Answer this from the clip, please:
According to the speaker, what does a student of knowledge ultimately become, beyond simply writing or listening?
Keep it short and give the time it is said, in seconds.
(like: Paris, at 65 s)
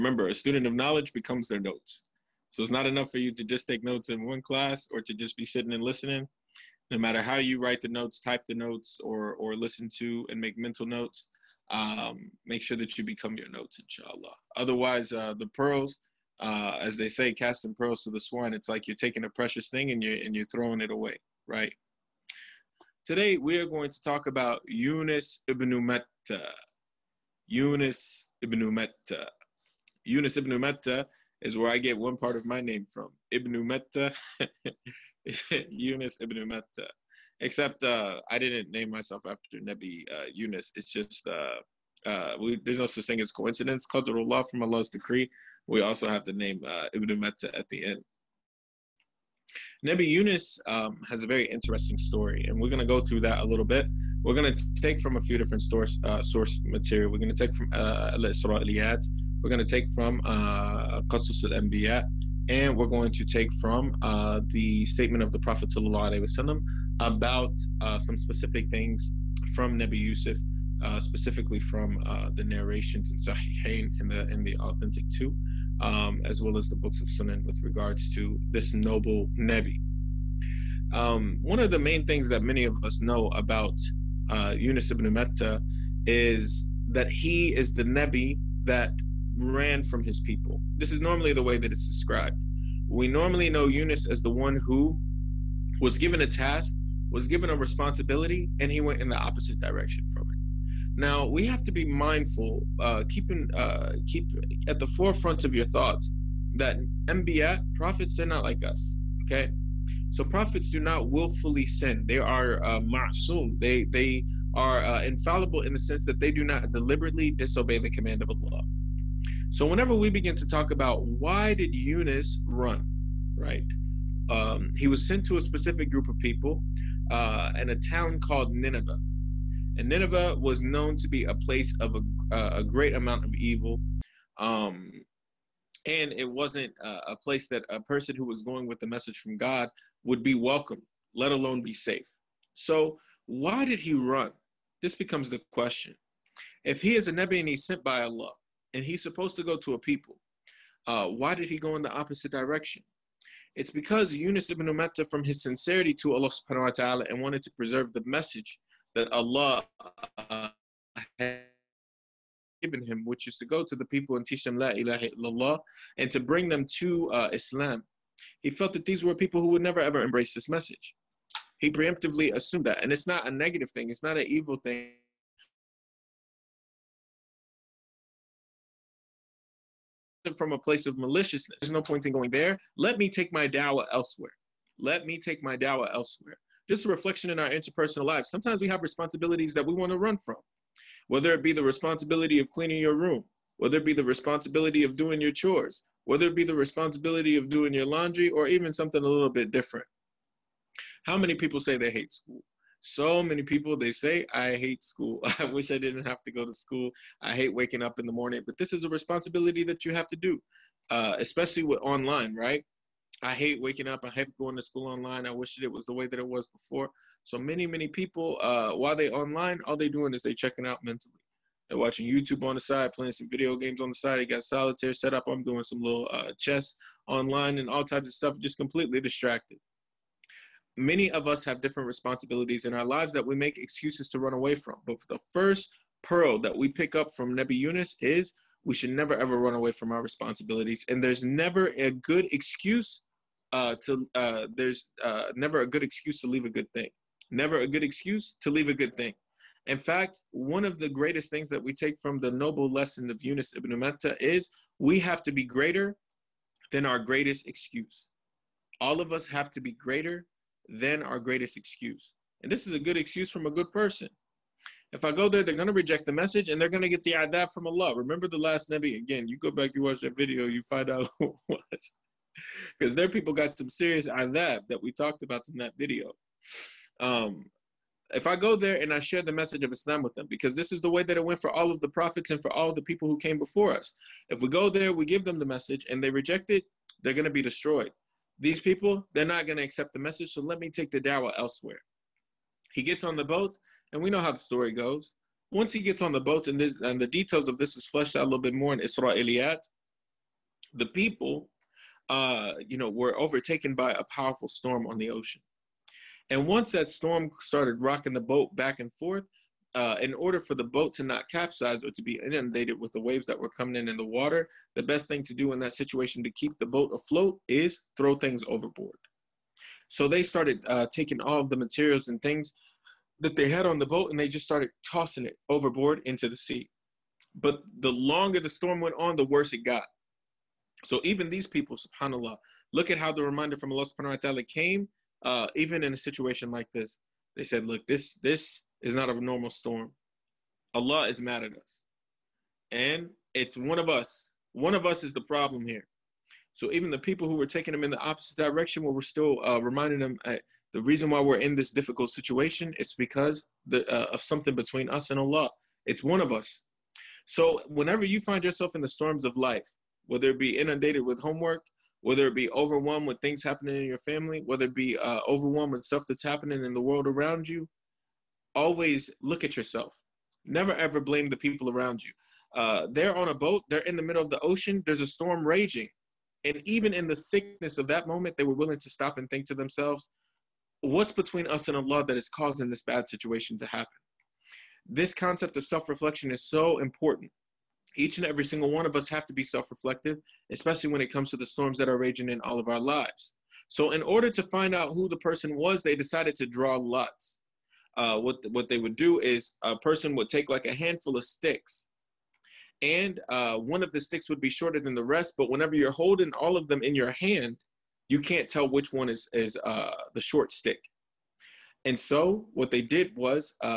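Their notes, at 1 s.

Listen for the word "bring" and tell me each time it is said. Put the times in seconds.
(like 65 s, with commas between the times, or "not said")
166 s.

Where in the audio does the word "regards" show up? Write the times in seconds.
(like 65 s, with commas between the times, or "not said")
77 s.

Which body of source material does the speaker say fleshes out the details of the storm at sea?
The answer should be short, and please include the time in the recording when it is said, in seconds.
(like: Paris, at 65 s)
Isra'iliyat, at 298 s.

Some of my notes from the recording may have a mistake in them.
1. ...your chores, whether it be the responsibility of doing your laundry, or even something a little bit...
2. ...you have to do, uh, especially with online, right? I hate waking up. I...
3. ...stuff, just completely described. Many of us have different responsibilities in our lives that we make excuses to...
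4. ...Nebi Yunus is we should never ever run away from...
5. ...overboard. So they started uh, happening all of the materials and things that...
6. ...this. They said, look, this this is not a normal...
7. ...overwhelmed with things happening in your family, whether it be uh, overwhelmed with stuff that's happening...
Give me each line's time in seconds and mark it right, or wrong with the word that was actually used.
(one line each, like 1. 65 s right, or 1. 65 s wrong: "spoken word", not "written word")
1. 195 s right
2. 209 s right
3. 228 s wrong: "distracted", not "described"
4. 237 s right
5. 318 s wrong: "taking", not "happening"
6. 336 s right
7. 362 s right.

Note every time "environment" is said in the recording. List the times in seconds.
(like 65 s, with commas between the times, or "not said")
not said.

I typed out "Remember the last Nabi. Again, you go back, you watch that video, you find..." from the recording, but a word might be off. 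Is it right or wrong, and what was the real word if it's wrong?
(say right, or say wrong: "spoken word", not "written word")
right.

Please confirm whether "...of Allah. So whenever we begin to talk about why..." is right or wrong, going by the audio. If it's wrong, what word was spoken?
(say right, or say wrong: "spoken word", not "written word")
right.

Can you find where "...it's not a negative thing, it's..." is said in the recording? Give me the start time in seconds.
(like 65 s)
172 s.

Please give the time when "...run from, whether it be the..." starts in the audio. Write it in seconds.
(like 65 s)
189 s.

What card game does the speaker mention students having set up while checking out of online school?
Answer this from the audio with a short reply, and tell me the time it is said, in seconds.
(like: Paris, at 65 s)
Solitaire, at 224 s.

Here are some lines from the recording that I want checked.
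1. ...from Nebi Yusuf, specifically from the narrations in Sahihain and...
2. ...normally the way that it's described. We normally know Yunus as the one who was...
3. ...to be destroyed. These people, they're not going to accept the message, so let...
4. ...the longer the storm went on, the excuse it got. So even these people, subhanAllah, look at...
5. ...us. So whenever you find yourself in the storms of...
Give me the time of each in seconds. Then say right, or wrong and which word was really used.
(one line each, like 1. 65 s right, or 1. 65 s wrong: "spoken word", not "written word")
1. 69 s right
2. 90 s right
3. 287 s right
4. 327 s wrong: "worse", not "excuse"
5. 356 s right.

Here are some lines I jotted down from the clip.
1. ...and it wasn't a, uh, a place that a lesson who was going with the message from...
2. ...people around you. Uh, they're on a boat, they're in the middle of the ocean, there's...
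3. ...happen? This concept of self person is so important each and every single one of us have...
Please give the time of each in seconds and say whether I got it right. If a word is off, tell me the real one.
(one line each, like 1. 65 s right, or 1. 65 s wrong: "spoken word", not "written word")
1. 135 s wrong: "person", not "lesson"
2. 371 s right
3. 383 s wrong: "reflection", not "person".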